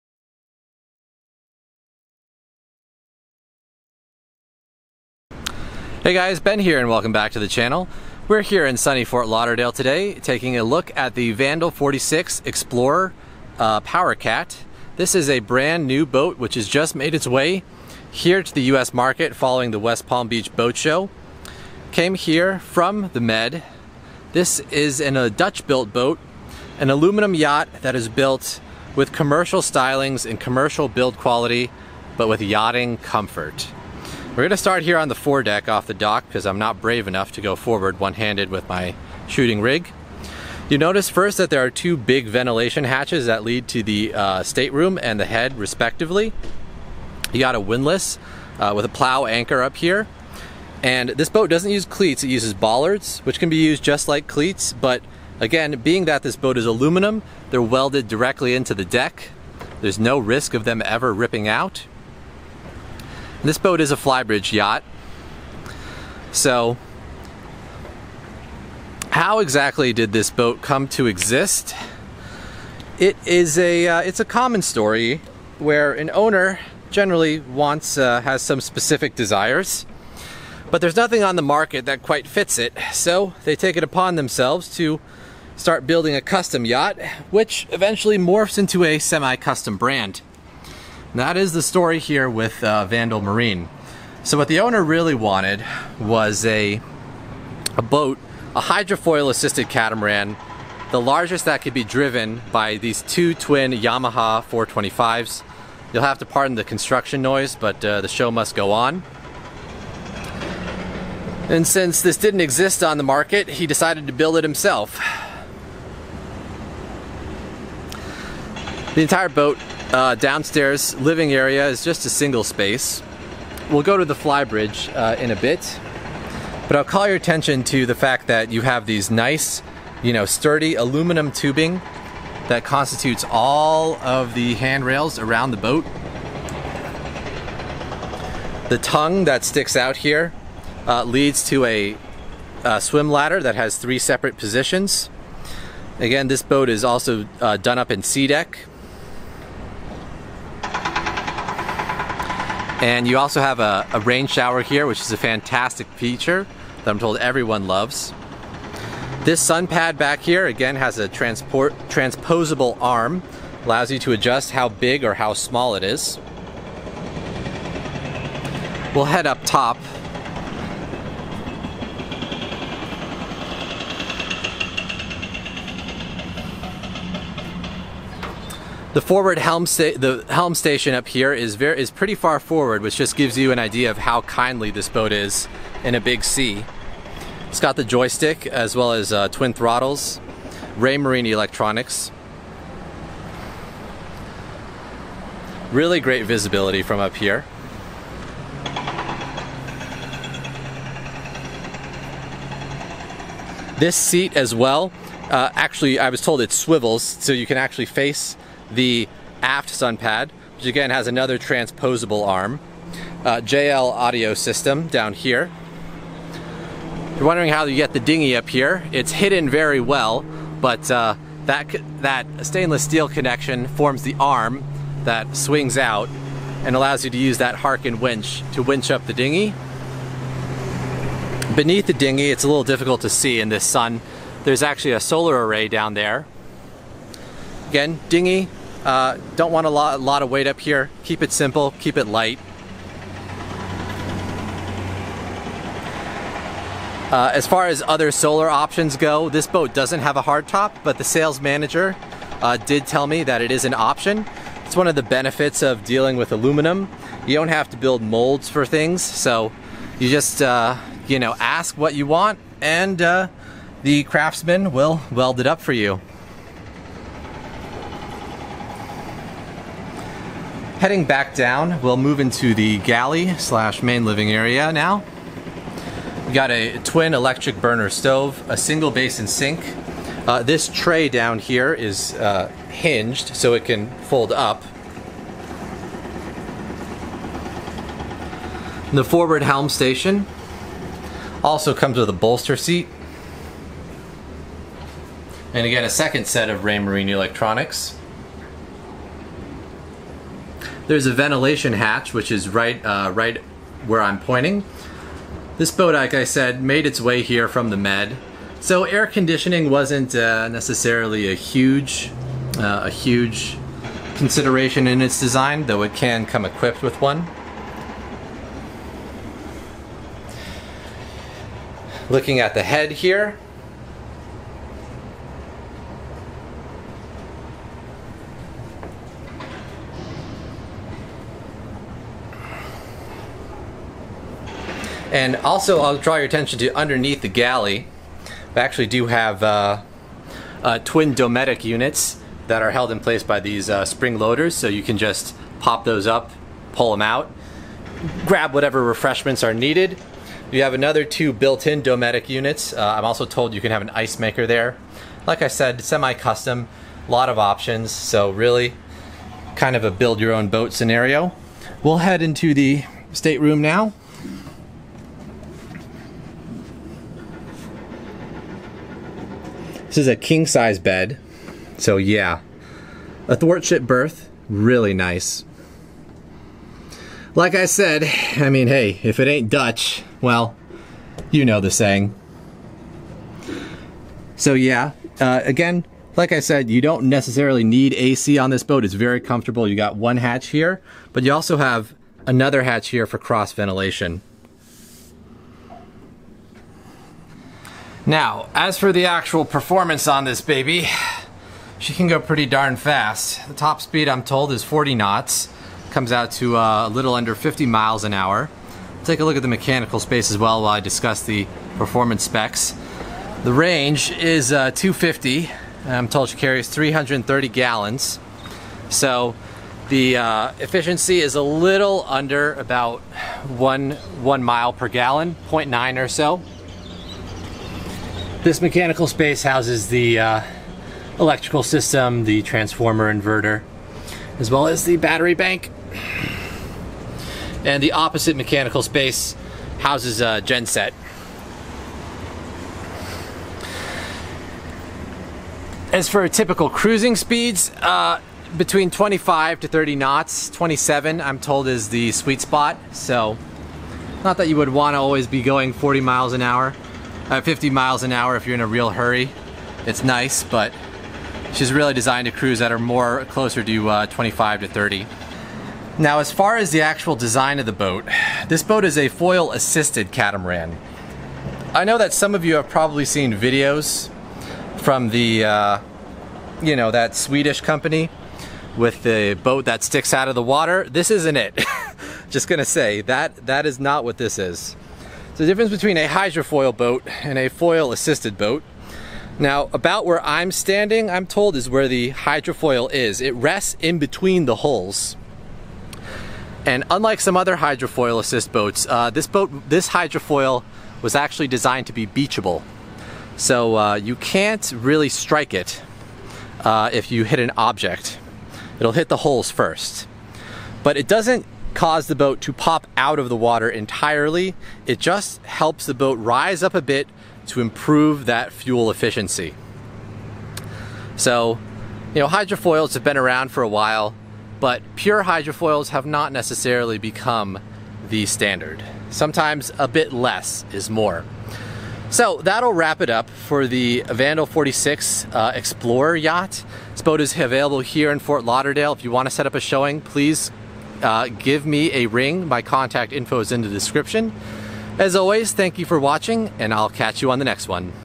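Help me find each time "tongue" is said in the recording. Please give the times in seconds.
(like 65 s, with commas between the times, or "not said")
138 s.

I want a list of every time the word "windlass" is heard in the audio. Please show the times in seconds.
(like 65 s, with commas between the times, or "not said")
47 s.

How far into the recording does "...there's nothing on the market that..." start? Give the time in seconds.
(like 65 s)
80 s.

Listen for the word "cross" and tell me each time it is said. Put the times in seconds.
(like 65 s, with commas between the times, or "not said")
393 s.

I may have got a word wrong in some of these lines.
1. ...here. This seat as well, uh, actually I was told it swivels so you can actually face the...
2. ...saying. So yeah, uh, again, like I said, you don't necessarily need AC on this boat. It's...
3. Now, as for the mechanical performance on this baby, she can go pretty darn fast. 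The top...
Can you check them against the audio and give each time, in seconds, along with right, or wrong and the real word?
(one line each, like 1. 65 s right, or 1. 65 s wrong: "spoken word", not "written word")
1. 197 s right
2. 381 s right
3. 398 s wrong: "actual", not "mechanical".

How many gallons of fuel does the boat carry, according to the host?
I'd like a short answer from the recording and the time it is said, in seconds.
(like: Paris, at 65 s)
330 gallons, at 416 s.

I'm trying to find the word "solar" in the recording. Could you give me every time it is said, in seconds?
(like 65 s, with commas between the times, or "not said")
234 s, 248 s.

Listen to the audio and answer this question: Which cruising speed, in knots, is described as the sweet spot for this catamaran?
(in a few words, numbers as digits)
27.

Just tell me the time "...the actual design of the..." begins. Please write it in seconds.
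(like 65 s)
466 s.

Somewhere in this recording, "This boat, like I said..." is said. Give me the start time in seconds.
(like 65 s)
305 s.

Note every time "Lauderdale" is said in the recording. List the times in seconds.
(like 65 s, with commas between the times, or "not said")
9 s, 538 s.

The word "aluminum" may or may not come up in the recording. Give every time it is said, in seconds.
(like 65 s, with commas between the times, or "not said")
26 s, 56 s, 130 s, 256 s.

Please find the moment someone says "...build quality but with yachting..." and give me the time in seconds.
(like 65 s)
30 s.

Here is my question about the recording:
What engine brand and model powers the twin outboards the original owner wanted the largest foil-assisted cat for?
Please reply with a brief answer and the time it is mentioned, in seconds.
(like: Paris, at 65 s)
Yamaha 425s, at 103 s.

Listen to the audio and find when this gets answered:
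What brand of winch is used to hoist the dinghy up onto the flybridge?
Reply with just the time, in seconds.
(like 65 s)
227 s.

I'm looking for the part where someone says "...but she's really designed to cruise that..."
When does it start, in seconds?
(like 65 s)
460 s.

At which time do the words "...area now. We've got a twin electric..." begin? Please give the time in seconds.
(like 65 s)
274 s.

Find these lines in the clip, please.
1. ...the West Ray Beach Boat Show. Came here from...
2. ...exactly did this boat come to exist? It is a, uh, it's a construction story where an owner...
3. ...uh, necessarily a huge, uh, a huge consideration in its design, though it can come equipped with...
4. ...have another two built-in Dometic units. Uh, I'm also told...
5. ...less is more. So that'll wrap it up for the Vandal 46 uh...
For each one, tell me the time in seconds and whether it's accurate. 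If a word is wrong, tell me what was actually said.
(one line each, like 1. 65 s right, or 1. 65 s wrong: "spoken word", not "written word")
1. 19 s wrong: "Palm", not "Ray"
2. 69 s wrong: "common", not "construction"
3. 310 s right
4. 350 s right
5. 530 s right.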